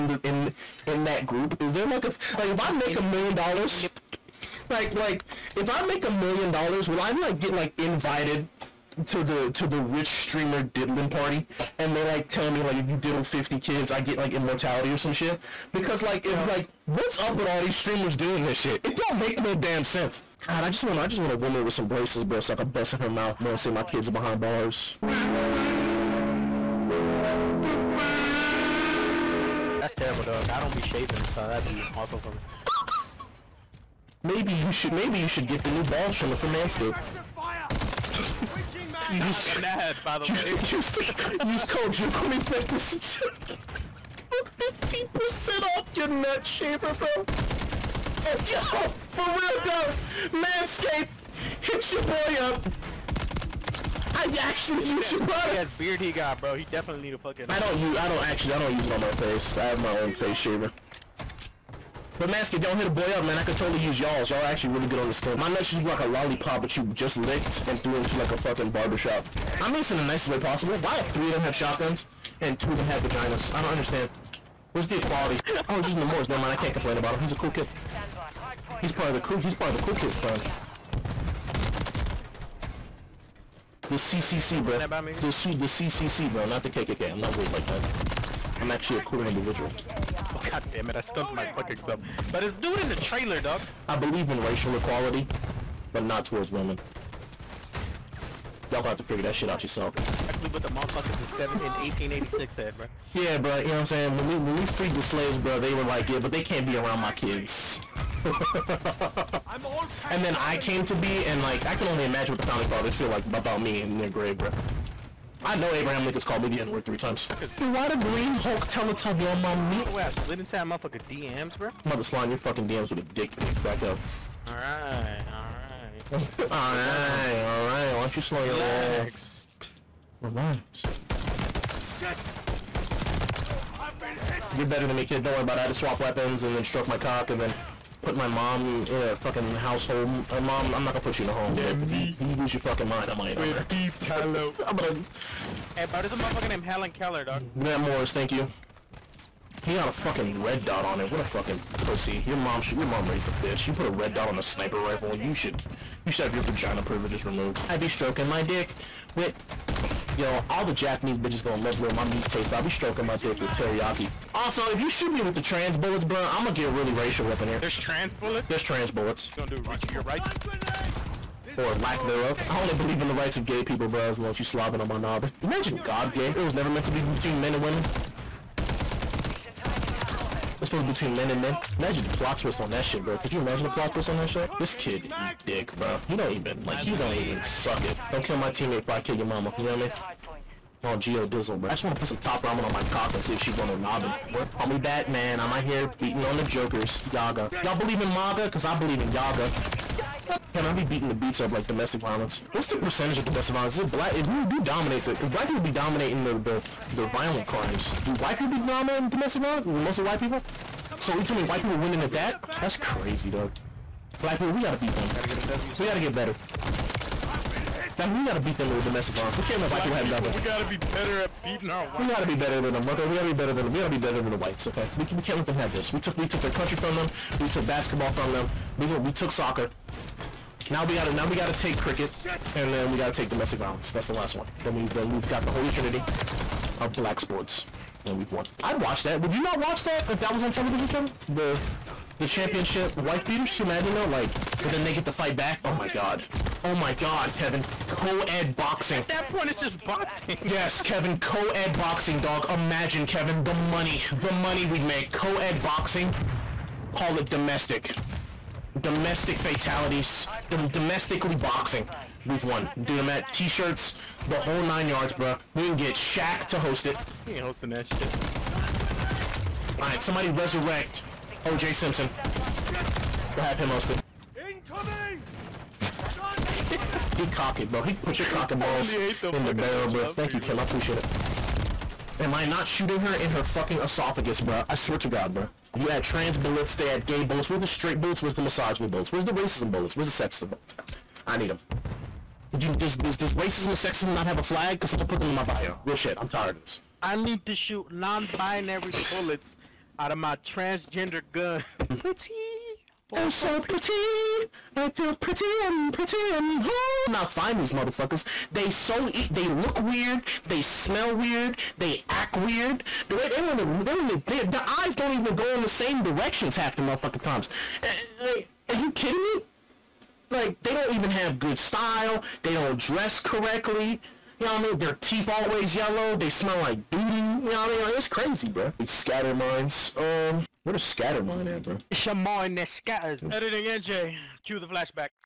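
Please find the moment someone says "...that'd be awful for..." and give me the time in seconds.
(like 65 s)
31 s.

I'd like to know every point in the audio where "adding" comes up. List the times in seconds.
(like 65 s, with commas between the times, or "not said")
not said.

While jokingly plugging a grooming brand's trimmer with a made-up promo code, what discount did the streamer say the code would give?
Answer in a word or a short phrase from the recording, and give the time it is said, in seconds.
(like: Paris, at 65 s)
15%, at 44 s.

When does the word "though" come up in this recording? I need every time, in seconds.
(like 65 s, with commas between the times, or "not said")
49 s, 243 s.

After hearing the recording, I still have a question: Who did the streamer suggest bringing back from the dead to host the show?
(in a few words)
OJ Simpson.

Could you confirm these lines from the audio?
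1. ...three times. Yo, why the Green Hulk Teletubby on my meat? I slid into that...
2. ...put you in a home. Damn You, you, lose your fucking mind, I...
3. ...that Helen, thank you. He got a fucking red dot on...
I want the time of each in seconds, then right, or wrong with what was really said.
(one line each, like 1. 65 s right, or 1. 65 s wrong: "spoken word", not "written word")
1. 116 s right
2. 141 s right
3. 147 s wrong: "MORS", not "Helen".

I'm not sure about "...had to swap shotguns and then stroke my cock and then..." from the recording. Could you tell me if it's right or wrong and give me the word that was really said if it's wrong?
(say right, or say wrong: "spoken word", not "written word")
wrong: "weapons", not "shotguns".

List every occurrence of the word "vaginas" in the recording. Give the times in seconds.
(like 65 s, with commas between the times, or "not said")
73 s, 156 s.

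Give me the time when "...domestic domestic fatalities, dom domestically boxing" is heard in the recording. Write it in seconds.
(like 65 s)
257 s.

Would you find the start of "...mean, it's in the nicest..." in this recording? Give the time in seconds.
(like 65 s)
69 s.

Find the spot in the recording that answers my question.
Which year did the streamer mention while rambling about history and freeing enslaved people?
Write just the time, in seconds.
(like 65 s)
101 s.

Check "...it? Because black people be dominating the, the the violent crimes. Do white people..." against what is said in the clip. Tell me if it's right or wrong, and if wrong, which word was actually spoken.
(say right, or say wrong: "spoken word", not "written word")
right.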